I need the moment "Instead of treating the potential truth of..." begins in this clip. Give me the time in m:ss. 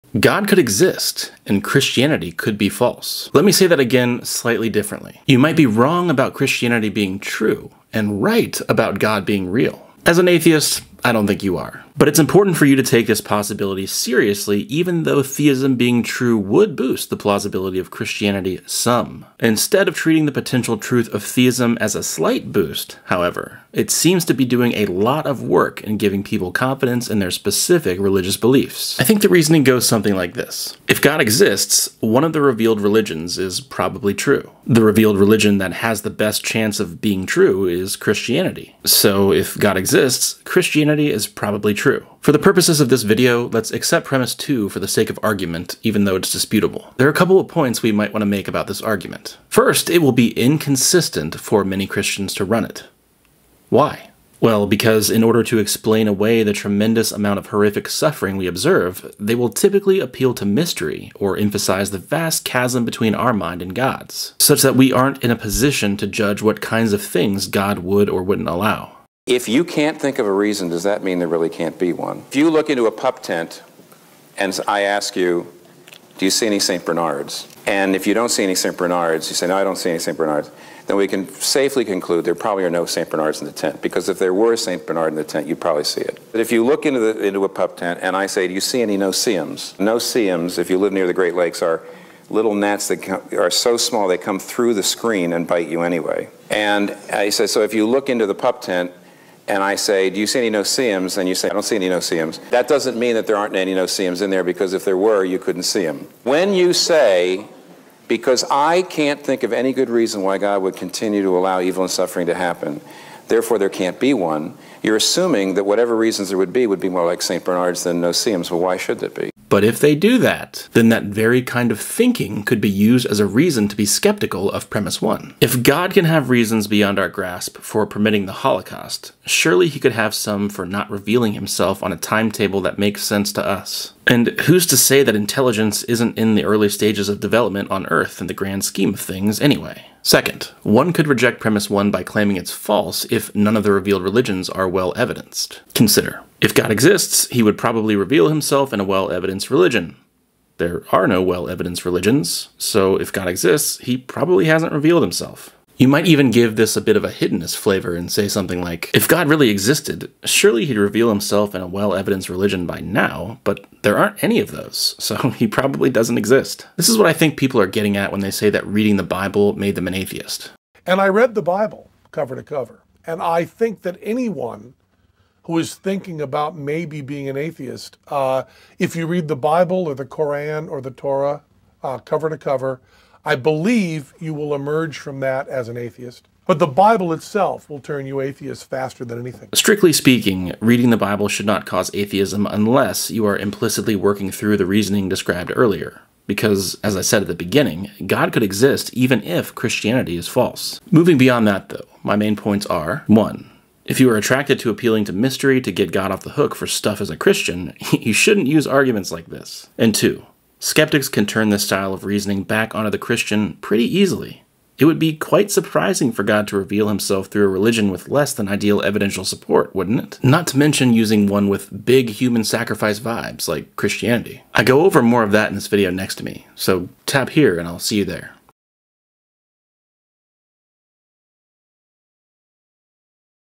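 0:19.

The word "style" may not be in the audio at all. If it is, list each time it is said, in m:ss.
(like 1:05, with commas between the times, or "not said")
3:31.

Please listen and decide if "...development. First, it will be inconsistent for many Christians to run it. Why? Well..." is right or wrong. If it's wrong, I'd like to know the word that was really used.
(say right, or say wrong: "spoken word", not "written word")
wrong: "argument", not "development".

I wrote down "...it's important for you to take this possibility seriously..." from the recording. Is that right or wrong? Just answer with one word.
right.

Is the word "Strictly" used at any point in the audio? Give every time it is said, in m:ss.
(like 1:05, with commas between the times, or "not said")
3:09.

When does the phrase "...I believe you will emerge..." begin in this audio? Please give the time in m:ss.
3:03.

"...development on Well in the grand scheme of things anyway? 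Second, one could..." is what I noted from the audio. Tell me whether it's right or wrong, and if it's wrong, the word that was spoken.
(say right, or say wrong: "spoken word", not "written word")
wrong: "Earth", not "Well".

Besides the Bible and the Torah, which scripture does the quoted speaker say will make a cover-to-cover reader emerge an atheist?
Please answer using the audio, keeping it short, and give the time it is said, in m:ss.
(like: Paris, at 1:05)
the Koran, at 3:00.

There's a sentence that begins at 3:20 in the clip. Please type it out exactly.
Moving beyond that, though, my main points are 1.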